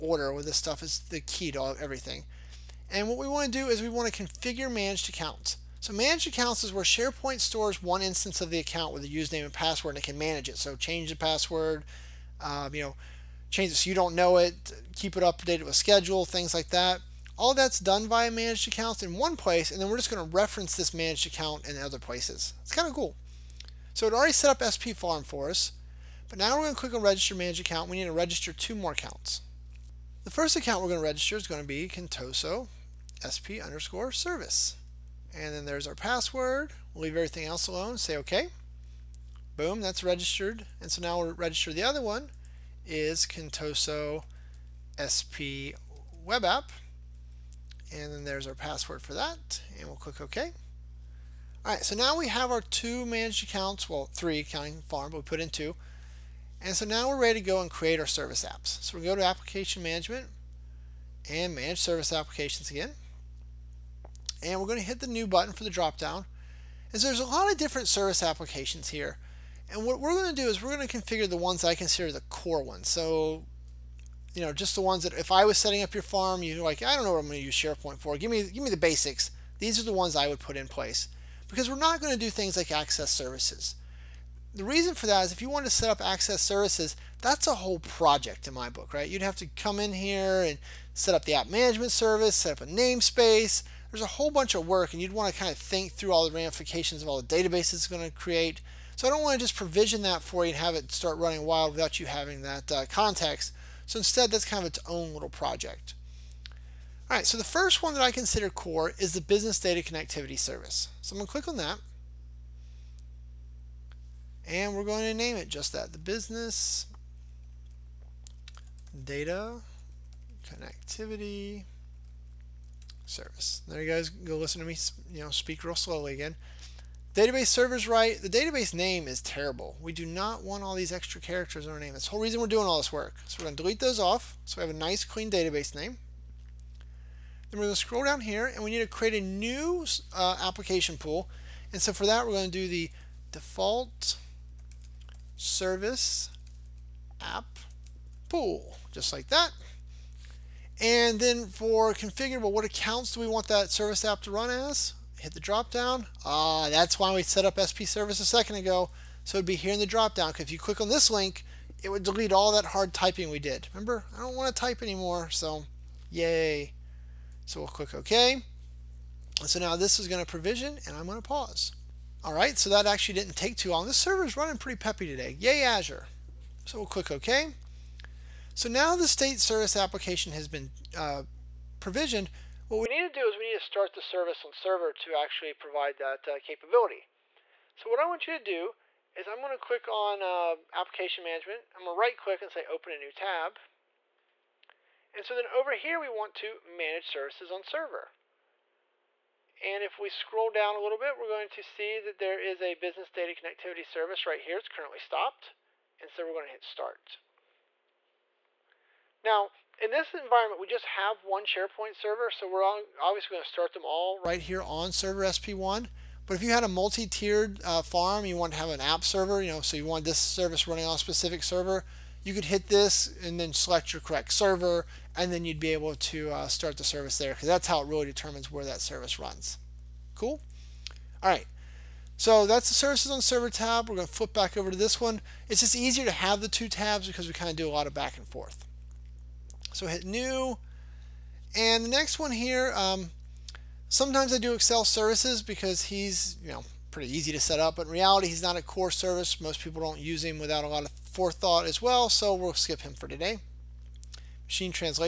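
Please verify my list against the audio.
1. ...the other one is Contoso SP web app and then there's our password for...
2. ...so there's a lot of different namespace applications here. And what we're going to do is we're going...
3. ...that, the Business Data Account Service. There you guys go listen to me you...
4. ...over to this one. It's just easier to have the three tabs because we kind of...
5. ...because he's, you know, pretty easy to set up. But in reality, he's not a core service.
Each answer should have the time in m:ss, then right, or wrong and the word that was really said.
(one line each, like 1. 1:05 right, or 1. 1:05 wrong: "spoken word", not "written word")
1. 0:41 right
2. 1:07 wrong: "service", not "namespace"
3. 1:55 wrong: "Connectivity", not "Account"
4. 3:54 wrong: "two", not "three"
5. 4:05 right.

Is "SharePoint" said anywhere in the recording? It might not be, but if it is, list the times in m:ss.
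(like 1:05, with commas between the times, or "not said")
0:06, 1:17, 3:31.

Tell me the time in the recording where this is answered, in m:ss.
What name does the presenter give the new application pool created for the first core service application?
2:23.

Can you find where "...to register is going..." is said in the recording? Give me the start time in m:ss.
0:30.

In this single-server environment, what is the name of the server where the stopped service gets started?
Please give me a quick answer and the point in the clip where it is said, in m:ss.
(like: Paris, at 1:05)
SP1, at 3:35.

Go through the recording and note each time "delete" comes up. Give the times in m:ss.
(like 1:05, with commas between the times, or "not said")
2:13, 2:42.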